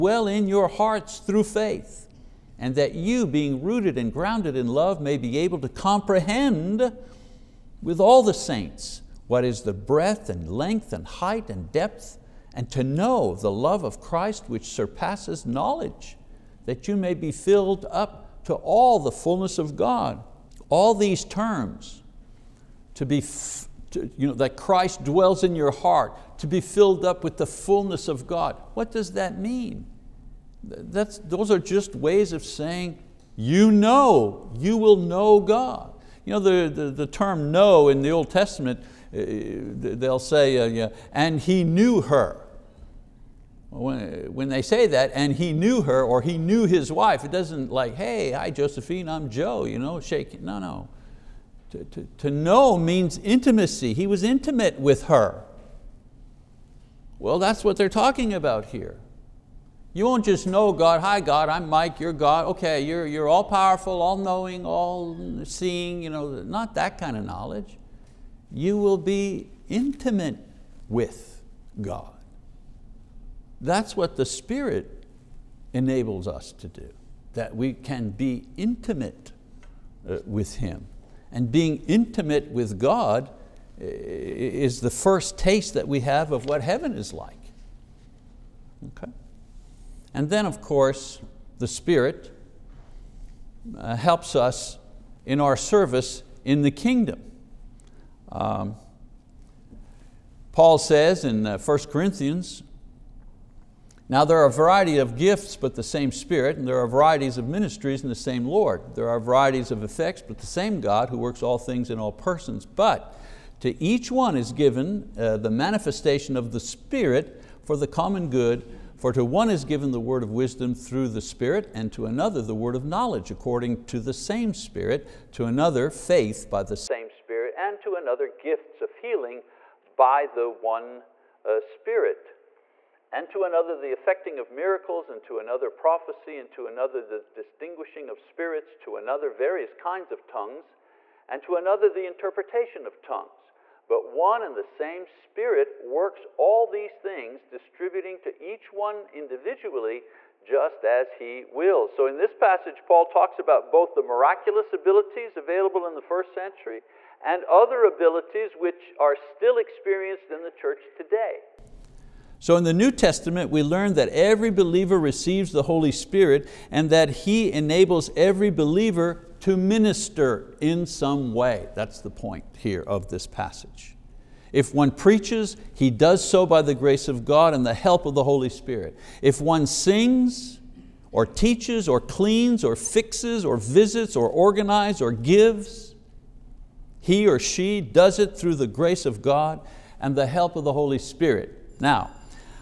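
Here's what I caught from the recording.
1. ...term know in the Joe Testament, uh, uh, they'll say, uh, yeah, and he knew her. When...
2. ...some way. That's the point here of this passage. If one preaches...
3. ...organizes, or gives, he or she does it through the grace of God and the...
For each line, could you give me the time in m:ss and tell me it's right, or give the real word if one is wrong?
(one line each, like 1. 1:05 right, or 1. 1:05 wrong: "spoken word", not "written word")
1. 0:37 wrong: "Old", not "Joe"
2. 2:50 right
3. 3:04 right.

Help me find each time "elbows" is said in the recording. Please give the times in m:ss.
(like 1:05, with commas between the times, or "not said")
not said.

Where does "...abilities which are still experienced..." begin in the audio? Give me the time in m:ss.
2:37.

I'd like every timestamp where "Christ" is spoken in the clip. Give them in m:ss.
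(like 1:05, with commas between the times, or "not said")
0:13, 0:24.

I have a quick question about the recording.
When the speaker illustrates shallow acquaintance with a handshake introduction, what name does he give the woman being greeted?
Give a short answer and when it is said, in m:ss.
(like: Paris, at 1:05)
Josephine, at 0:48.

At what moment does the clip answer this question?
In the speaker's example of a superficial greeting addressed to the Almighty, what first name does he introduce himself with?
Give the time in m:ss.
1:01.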